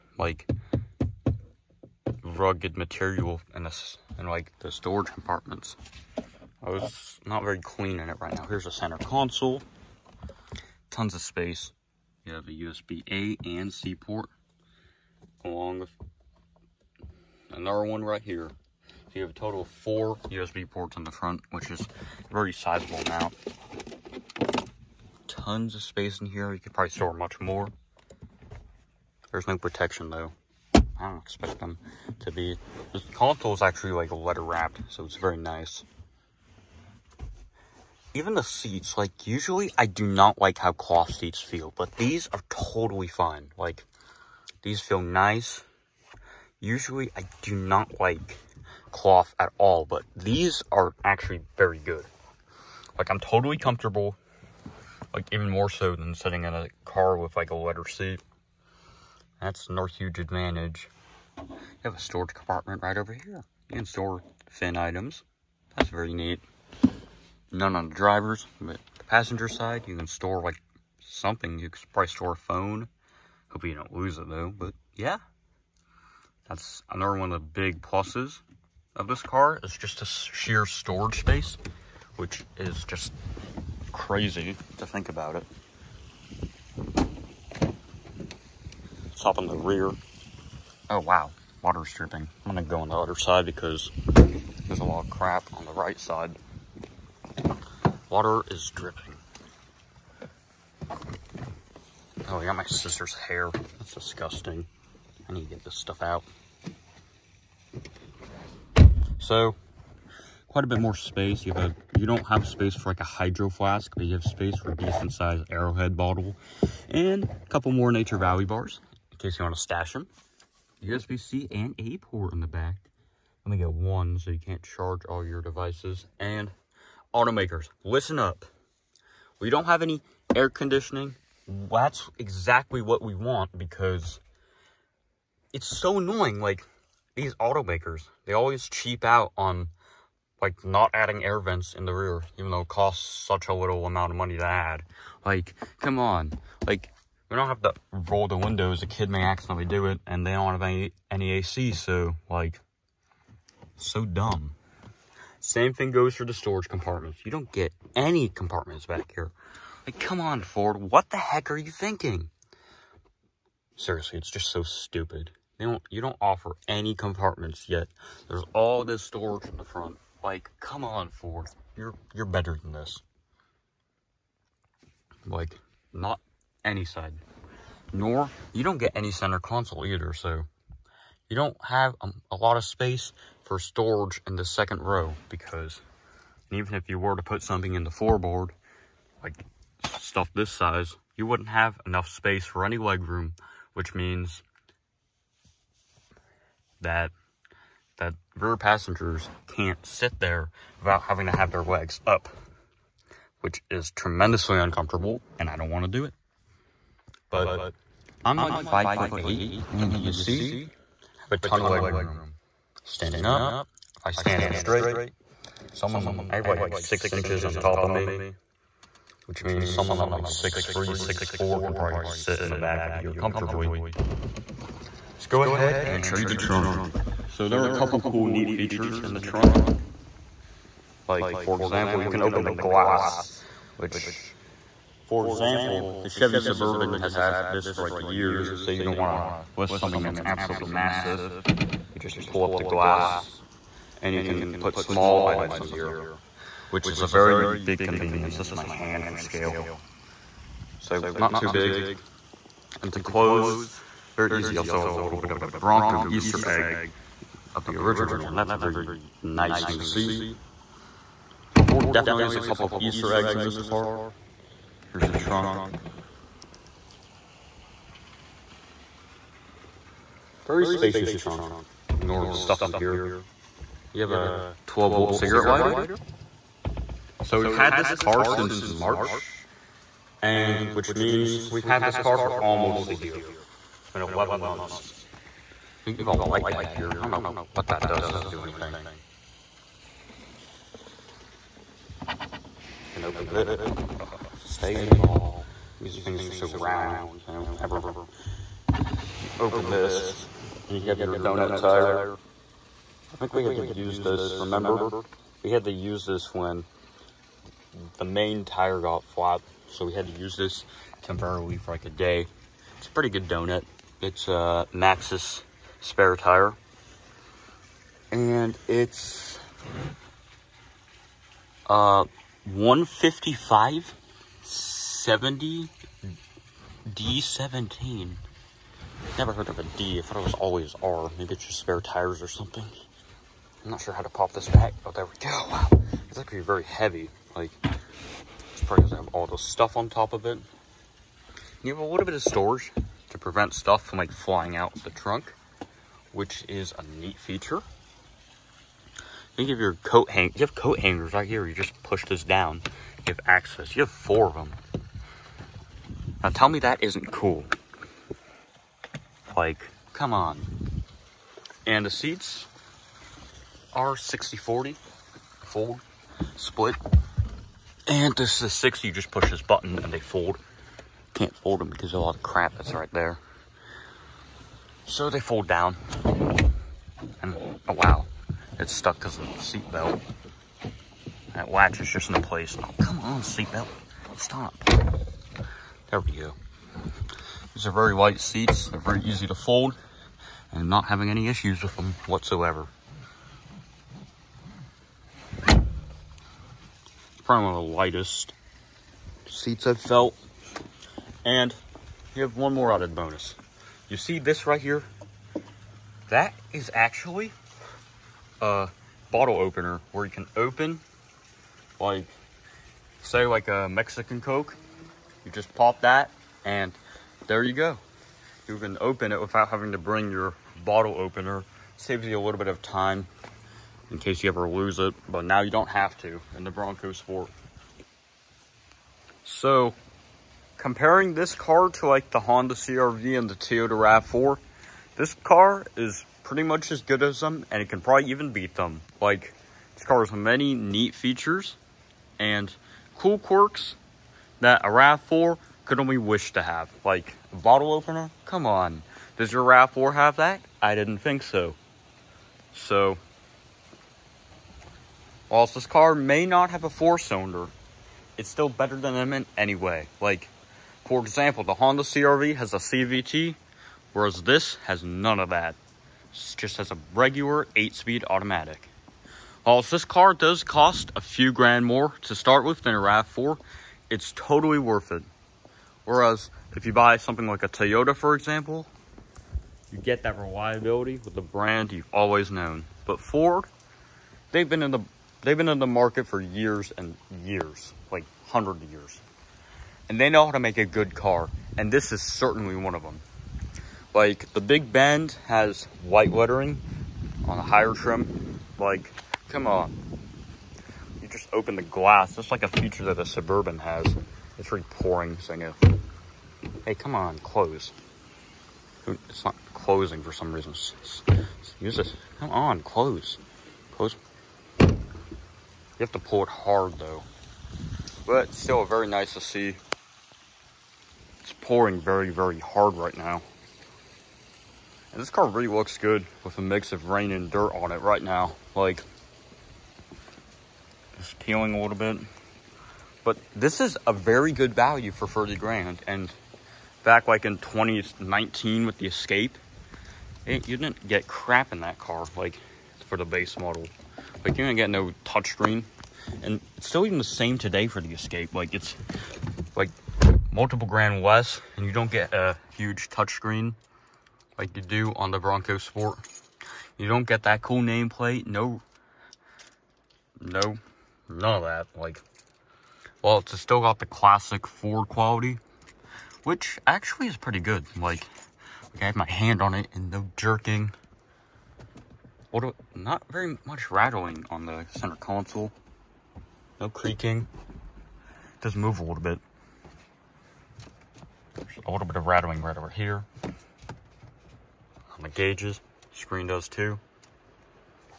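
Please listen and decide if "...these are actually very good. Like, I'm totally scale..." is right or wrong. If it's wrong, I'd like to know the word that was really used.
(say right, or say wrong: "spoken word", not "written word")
wrong: "comfortable", not "scale".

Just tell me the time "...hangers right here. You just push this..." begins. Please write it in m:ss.
5:50.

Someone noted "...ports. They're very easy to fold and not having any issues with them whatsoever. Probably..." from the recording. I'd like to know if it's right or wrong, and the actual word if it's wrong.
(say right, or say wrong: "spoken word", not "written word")
wrong: "seats", not "ports".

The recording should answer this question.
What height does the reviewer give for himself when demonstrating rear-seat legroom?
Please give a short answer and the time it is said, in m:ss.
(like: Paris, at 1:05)
5 foot 8, at 3:28.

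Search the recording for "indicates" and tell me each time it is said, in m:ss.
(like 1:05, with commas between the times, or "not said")
not said.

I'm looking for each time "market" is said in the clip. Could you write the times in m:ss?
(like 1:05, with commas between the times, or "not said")
8:05.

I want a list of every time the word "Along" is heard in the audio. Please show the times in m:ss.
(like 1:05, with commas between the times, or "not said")
0:15.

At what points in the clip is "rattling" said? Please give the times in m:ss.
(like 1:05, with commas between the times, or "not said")
9:33, 9:42.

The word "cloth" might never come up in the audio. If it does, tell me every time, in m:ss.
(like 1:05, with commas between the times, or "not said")
0:40, 0:48.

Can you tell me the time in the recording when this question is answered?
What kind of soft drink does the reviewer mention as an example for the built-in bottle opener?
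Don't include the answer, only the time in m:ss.
6:53.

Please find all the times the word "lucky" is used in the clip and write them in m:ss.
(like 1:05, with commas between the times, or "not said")
not said.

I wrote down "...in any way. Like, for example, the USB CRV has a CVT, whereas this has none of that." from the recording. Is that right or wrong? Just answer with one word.
wrong.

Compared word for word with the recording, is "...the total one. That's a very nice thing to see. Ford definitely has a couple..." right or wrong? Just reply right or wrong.
wrong.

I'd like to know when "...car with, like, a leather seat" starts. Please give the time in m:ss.
0:56.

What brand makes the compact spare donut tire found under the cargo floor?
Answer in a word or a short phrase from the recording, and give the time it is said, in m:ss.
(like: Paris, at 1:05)
Maxxis, at 5:14.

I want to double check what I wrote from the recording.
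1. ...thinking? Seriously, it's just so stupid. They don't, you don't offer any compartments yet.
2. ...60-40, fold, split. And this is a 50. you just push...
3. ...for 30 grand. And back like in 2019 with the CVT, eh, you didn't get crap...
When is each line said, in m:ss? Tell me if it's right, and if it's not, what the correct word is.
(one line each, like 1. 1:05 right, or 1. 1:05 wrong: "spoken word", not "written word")
1. 2:41 right
2. 6:03 wrong: "60", not "50"
3. 8:54 wrong: "Escape", not "CVT".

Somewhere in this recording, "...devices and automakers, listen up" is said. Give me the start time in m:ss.
2:05.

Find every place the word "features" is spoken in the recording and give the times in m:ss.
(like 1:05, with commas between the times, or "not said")
3:48, 5:47, 7:20, 8:22.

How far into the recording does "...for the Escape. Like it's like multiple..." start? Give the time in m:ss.
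9:07.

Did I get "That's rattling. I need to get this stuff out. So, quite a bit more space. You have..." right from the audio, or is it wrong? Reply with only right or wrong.
wrong.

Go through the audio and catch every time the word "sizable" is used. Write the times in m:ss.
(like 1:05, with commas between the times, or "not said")
0:22.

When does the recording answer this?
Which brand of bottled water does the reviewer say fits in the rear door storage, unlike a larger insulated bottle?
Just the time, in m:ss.
1:55.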